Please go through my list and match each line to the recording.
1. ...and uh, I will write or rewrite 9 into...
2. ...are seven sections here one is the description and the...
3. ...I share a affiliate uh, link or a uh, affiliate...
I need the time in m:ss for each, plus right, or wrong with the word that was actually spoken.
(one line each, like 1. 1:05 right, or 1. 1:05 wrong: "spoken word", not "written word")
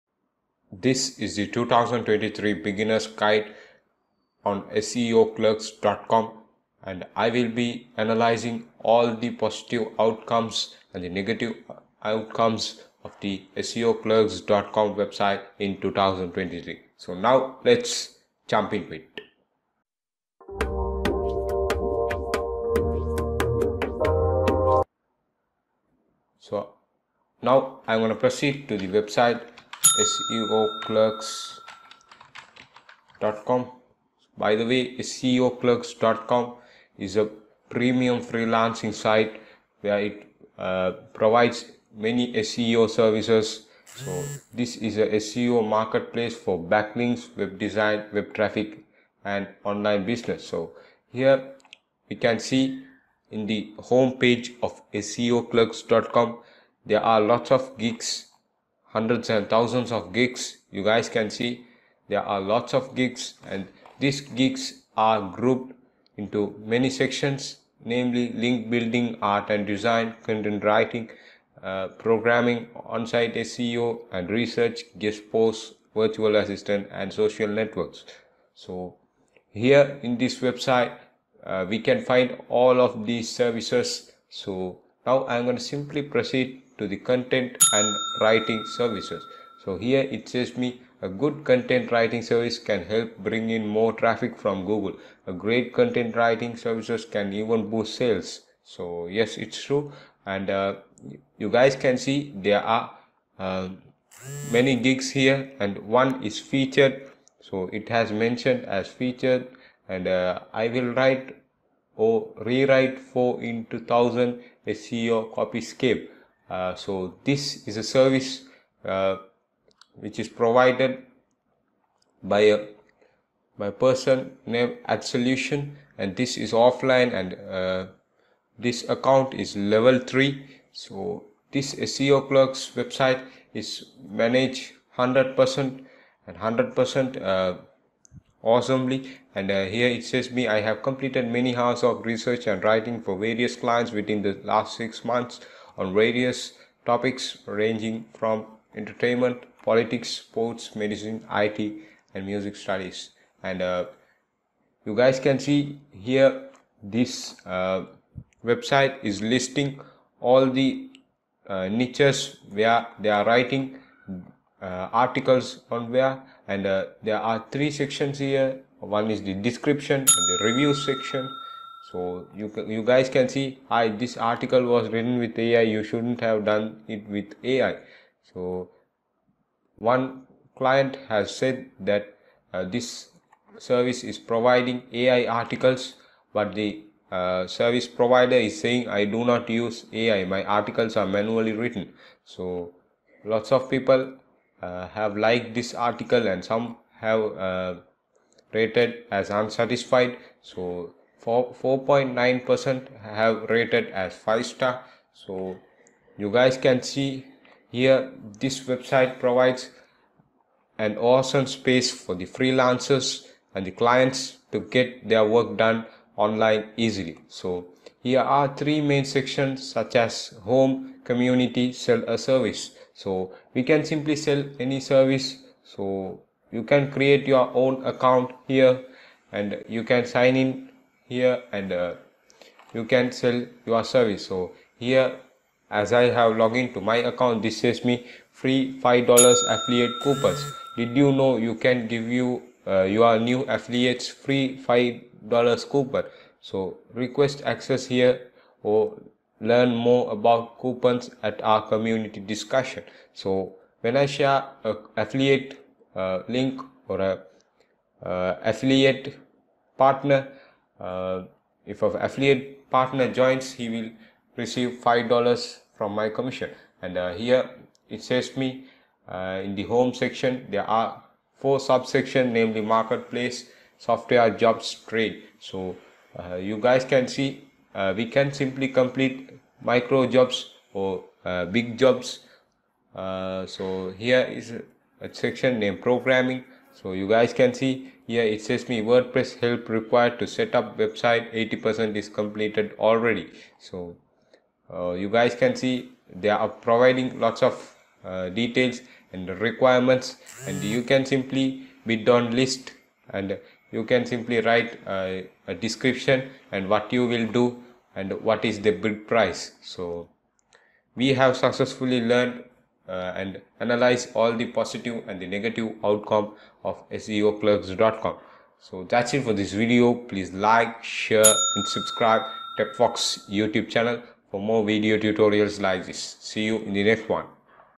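1. 1:49 wrong: "4", not "9"
2. 2:47 wrong: "three", not "seven"
3. 4:13 right.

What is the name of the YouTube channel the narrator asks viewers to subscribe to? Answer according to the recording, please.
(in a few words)
TechFox.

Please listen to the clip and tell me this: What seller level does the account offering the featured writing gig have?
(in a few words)
Level 3.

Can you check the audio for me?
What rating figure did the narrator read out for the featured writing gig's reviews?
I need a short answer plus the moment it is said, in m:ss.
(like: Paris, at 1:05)
4.9 percent, at 3:21.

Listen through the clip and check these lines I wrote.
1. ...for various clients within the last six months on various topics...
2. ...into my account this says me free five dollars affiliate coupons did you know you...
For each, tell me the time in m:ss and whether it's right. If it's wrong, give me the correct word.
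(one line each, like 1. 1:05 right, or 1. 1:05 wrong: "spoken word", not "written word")
1. 2:23 right
2. 3:56 right.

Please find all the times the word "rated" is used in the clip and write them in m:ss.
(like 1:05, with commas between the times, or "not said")
3:18, 3:23.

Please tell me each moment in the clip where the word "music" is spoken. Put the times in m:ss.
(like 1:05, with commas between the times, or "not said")
2:32.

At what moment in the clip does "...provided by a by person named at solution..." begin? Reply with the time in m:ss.
2:00.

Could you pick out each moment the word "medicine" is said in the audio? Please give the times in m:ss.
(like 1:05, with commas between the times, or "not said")
2:30.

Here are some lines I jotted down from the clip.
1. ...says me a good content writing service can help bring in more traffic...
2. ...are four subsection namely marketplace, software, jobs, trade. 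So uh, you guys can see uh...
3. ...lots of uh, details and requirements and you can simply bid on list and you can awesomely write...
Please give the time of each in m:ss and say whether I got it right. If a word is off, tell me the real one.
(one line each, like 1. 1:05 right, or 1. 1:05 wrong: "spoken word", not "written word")
1. 1:30 right
2. 4:30 right
3. 4:57 wrong: "simply", not "awesomely".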